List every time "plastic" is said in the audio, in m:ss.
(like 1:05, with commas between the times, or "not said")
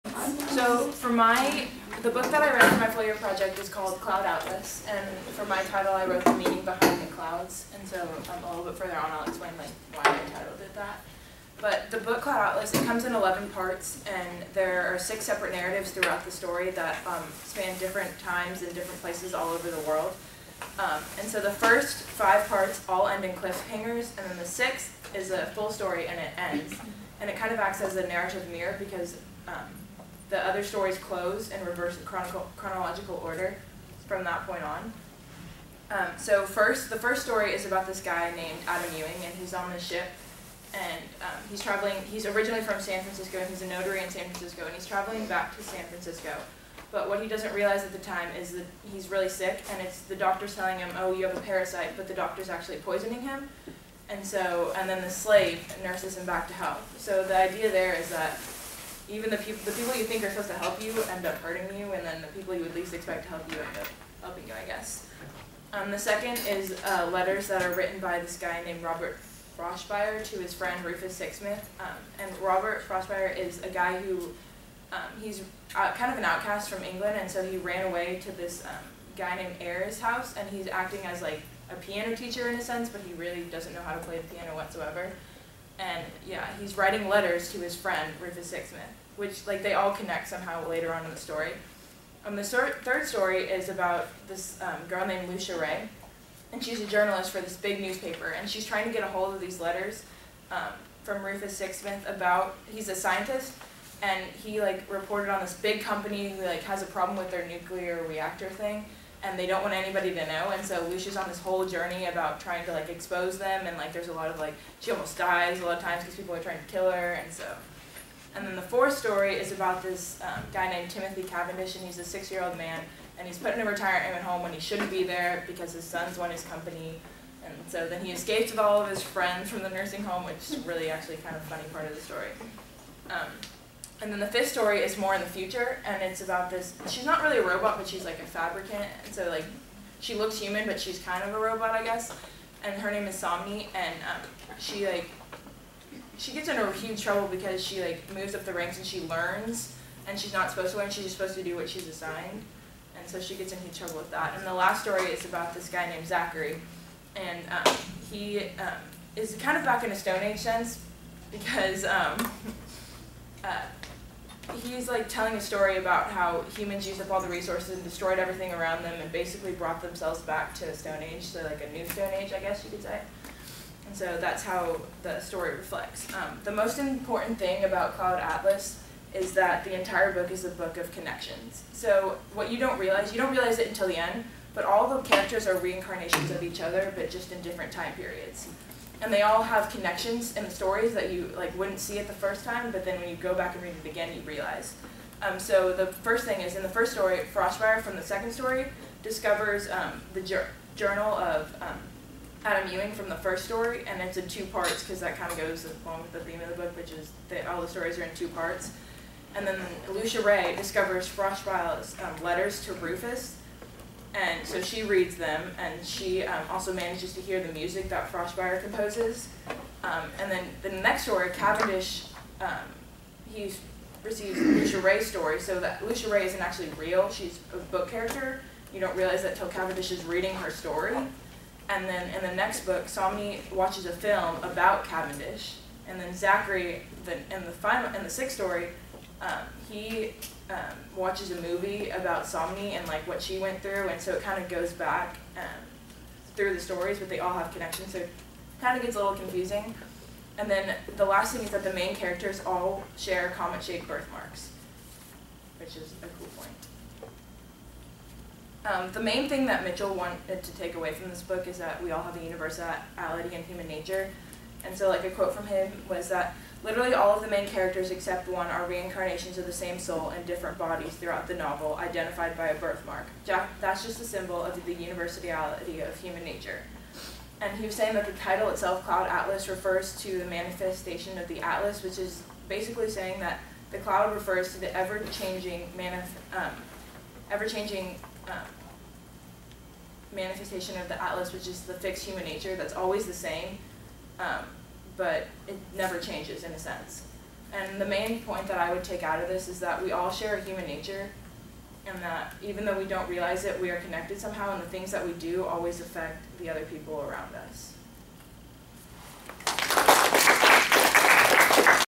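not said.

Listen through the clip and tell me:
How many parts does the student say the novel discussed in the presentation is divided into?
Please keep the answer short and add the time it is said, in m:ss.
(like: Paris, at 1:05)
11, at 0:13.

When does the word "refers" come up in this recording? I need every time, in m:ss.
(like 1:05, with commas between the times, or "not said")
4:39, 4:44.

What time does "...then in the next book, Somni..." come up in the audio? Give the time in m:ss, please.
3:51.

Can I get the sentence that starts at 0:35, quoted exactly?
Um, so first, the first story is about this guy named Adam Ewing, and he's on the ship, and um, he's traveling.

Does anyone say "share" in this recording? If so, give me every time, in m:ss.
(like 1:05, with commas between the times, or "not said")
4:12, 5:00.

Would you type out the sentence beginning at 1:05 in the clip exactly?
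Um, the second is uh, letters that are written by this guy named Robert Frobisher to his friend Rufus Sixsmith.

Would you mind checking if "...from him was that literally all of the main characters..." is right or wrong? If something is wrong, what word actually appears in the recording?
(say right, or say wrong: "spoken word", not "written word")
right.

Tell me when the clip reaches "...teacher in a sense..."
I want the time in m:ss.
1:22.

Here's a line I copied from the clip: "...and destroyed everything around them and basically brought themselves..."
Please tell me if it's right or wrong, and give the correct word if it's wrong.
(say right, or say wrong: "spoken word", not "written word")
right.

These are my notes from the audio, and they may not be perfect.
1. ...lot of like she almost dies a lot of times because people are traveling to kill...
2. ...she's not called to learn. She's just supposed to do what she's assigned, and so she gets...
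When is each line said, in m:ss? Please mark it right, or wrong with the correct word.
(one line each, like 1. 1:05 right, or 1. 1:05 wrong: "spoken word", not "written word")
1. 1:54 wrong: "trying", not "traveling"
2. 2:30 wrong: "supposed", not "called".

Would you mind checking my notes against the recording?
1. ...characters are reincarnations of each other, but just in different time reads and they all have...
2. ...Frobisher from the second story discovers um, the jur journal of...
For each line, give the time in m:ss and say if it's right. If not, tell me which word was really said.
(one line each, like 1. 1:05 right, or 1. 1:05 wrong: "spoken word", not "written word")
1. 3:05 wrong: "periods", not "reads"
2. 3:17 right.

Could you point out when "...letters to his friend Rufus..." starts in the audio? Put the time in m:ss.
1:27.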